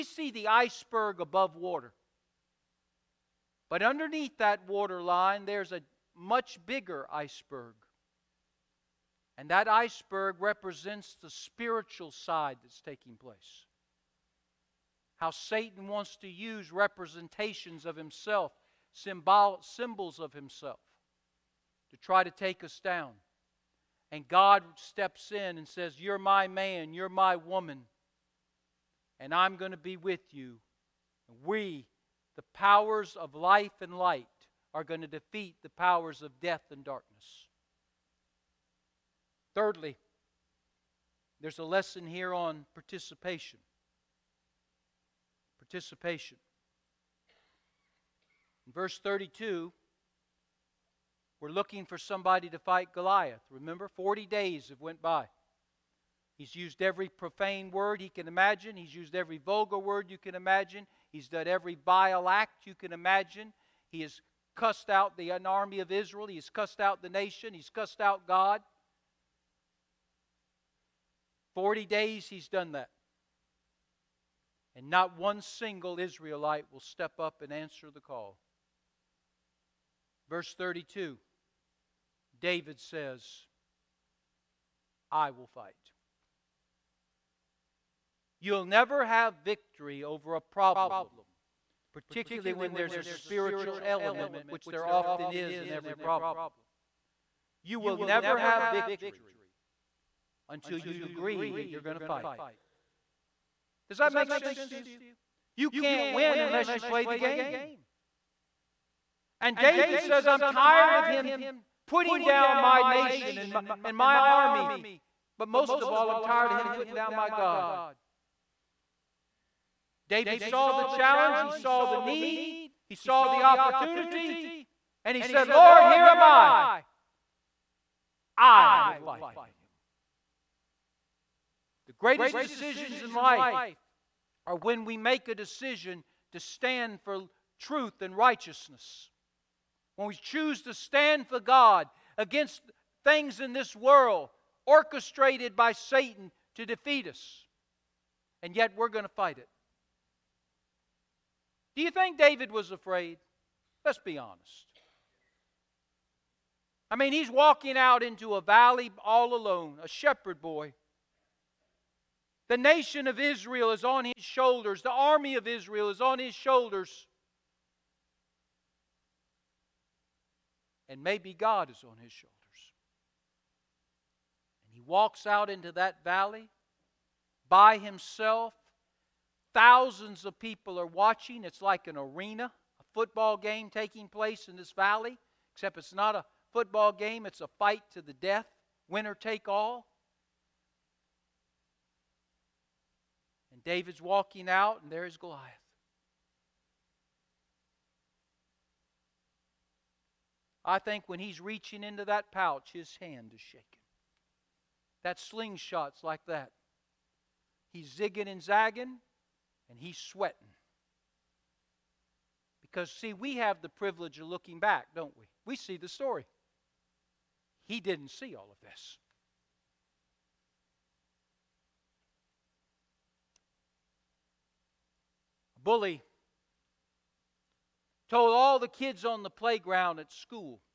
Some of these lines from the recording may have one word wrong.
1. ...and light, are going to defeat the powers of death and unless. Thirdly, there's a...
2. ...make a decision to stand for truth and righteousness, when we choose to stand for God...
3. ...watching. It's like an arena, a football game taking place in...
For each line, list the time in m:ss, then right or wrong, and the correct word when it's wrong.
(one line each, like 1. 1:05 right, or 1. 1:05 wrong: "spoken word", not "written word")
1. 0:33 wrong: "darkness", not "unless"
2. 2:14 right
3. 3:00 right.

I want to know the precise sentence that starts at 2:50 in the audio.
And maybe God is on his shoulders.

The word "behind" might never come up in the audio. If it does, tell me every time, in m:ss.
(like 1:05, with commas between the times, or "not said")
not said.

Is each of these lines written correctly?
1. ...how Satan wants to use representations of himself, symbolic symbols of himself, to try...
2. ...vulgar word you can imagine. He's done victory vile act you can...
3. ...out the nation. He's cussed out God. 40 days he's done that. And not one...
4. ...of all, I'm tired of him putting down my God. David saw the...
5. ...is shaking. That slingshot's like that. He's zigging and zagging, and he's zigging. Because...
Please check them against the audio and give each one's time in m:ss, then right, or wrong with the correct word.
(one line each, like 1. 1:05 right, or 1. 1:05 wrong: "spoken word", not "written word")
1. 0:15 right
2. 0:59 wrong: "every", not "victory"
3. 1:06 right
4. 1:55 right
5. 3:23 wrong: "sweating", not "zigging".